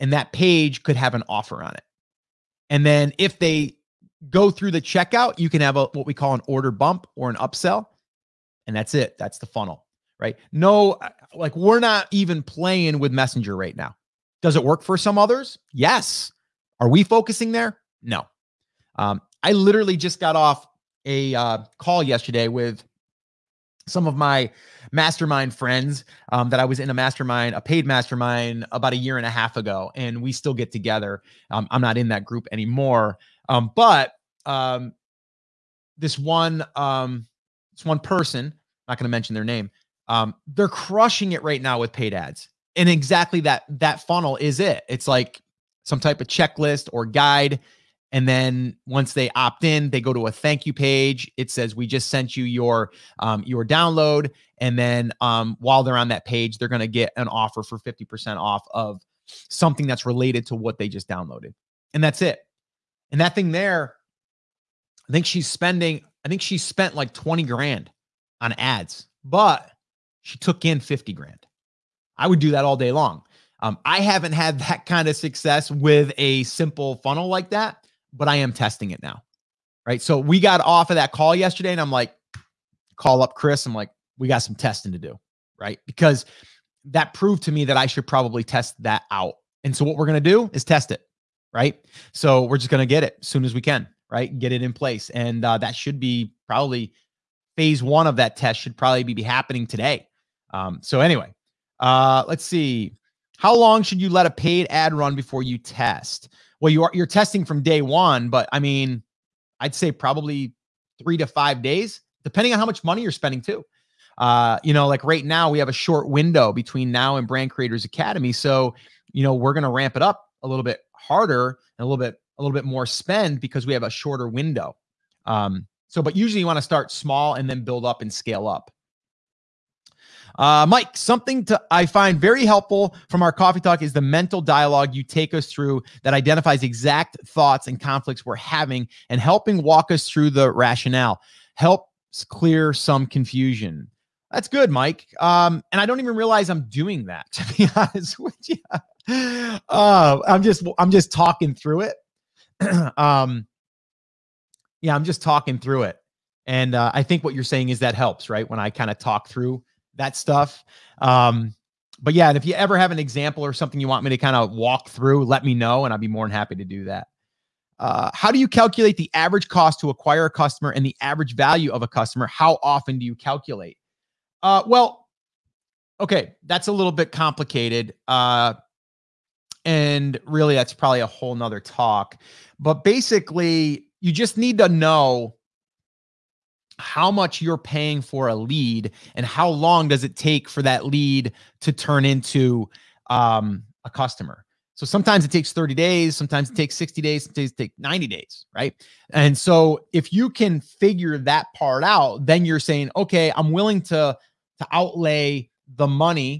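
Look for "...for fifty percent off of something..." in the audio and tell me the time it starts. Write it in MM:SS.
00:57.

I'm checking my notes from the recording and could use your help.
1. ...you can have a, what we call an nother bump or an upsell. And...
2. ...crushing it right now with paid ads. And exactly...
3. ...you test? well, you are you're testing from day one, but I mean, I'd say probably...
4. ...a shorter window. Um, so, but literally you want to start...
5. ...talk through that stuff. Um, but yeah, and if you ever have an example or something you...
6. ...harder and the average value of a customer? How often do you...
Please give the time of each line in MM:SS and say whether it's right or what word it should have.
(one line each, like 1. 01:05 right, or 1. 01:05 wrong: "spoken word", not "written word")
1. 00:05 wrong: "order", not "nother"
2. 00:40 right
3. 01:45 right
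4. 02:03 wrong: "usually", not "literally"
5. 02:38 right
6. 02:50 wrong: "customer", not "harder".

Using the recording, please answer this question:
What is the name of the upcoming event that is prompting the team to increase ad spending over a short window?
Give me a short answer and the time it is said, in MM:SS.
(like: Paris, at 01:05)
Brand Creators Academy, at 01:57.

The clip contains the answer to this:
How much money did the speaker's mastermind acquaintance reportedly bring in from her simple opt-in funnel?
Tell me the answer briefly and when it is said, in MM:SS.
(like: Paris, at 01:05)
$50,000, at 01:10.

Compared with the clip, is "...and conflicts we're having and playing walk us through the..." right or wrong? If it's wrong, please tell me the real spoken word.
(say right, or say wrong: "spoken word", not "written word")
wrong: "helping", not "playing".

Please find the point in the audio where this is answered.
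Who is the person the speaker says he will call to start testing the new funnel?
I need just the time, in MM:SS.
01:23.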